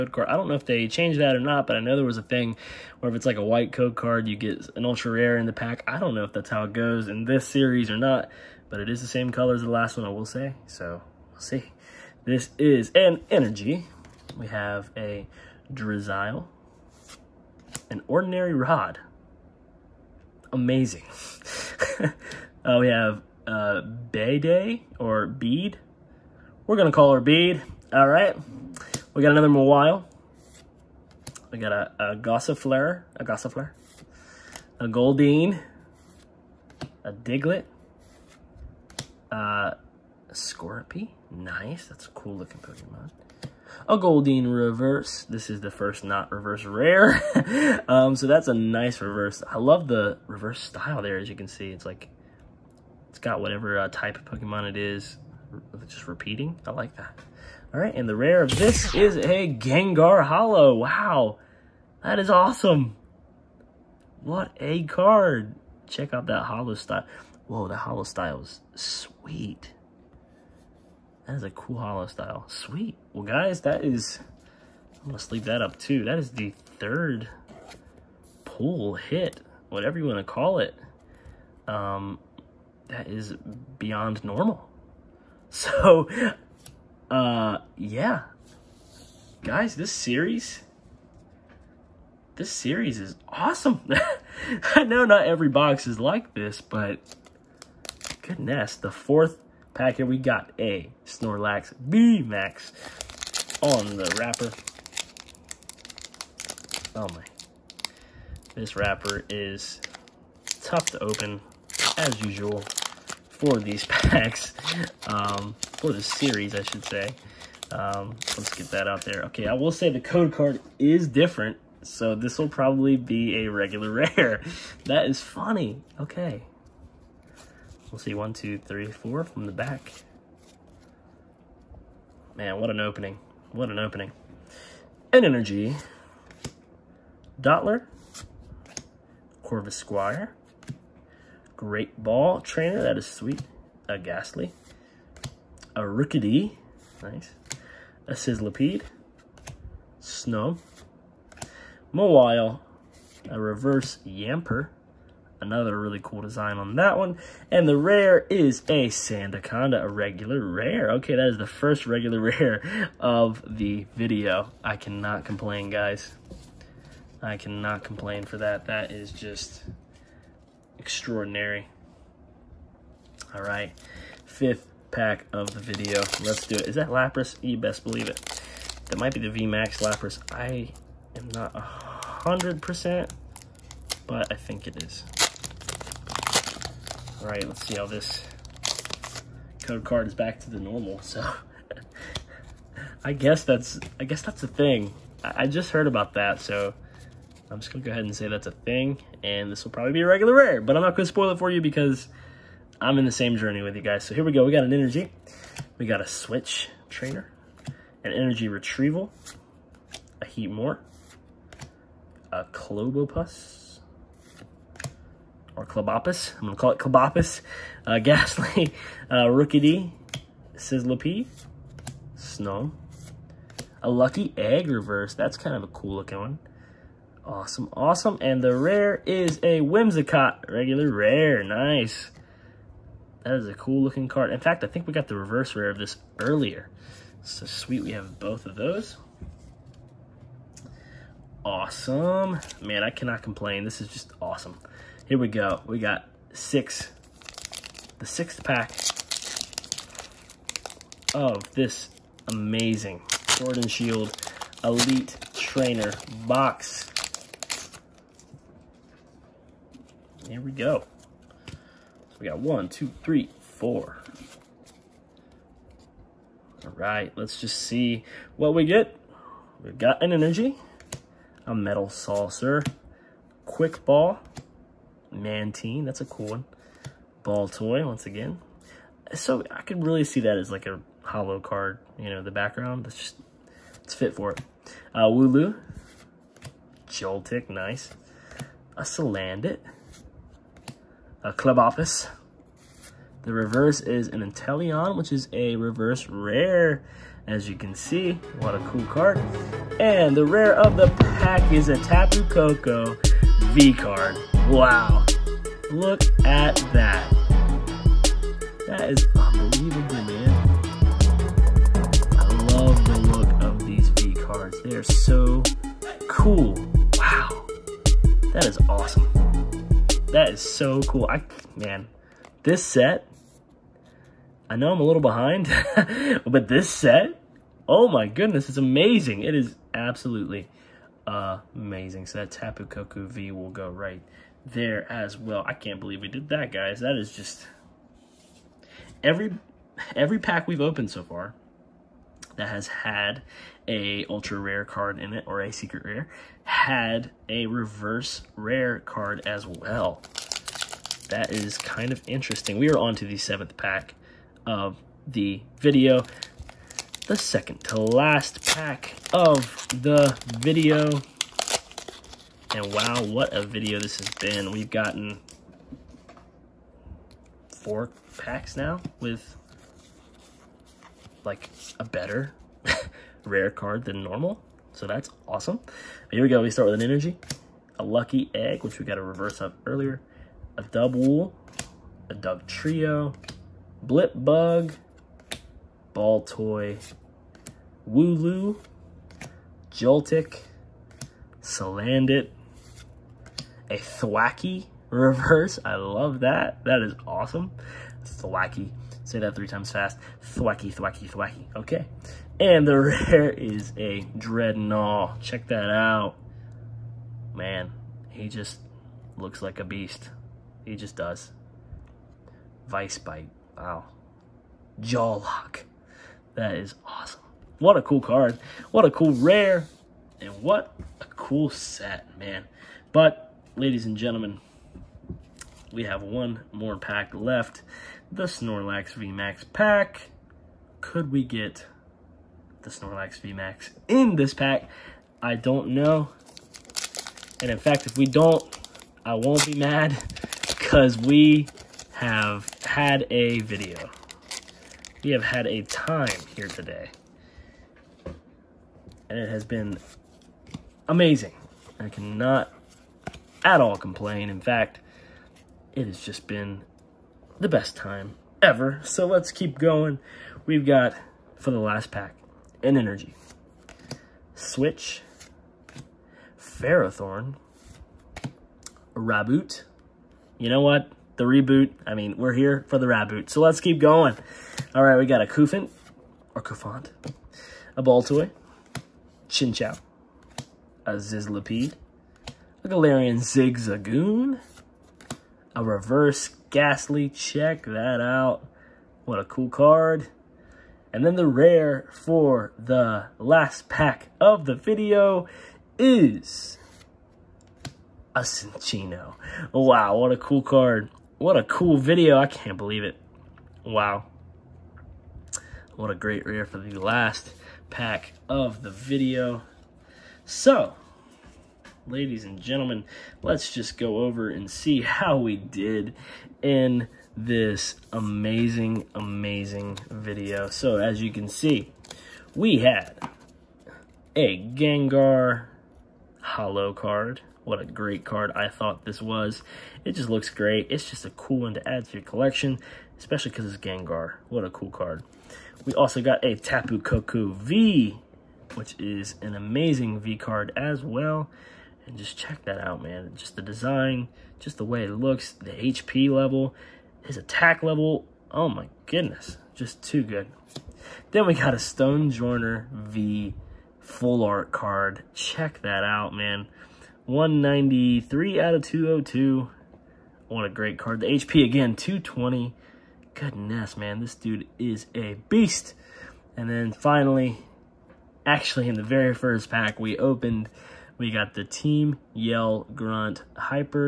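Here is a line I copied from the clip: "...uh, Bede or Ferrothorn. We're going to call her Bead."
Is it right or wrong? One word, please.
wrong.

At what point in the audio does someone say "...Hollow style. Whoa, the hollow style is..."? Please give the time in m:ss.
1:06.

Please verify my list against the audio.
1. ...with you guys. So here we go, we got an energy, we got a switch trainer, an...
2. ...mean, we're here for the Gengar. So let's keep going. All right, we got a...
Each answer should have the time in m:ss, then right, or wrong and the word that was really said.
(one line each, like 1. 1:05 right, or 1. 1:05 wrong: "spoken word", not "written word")
1. 3:23 right
2. 7:51 wrong: "Raboot", not "Gengar".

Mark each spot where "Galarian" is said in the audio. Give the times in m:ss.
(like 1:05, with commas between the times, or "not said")
8:02.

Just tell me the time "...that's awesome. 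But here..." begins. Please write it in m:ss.
6:14.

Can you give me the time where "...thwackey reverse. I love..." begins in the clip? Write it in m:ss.
6:33.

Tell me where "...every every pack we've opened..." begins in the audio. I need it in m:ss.
5:39.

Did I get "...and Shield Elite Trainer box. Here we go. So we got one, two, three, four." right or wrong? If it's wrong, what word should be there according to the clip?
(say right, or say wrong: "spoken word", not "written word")
right.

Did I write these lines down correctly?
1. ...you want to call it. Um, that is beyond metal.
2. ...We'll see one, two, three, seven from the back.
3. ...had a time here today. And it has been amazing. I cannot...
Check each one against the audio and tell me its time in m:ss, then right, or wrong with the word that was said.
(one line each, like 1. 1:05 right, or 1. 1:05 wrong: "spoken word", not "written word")
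1. 1:19 wrong: "normal", not "metal"
2. 2:07 wrong: "four", not "seven"
3. 7:25 right.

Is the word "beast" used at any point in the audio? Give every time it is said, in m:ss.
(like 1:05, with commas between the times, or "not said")
6:49, 9:25.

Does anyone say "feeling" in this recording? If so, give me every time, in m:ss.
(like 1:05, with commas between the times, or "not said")
not said.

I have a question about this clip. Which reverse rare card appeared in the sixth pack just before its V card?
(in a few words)
Inteleon.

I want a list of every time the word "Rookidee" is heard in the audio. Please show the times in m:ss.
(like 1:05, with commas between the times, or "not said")
2:25, 3:39.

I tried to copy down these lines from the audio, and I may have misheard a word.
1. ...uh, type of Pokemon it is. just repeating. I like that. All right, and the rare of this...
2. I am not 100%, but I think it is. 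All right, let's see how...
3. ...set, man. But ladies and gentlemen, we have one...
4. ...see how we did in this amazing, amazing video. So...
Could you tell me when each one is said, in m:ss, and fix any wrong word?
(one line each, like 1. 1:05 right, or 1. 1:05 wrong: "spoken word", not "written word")
1. 0:53 right
2. 3:00 right
3. 7:01 right
4. 8:34 right.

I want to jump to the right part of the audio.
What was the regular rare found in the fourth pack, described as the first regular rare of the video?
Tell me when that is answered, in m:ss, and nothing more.
2:38.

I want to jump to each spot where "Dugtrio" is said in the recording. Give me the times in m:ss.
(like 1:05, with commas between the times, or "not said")
6:22.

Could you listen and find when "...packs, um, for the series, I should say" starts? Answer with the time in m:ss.
1:53.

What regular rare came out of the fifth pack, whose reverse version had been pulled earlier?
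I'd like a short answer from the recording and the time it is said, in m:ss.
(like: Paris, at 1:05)
Whimsicott, at 3:49.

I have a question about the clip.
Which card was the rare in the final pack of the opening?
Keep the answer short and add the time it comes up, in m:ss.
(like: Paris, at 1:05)
Cinccino, at 8:18.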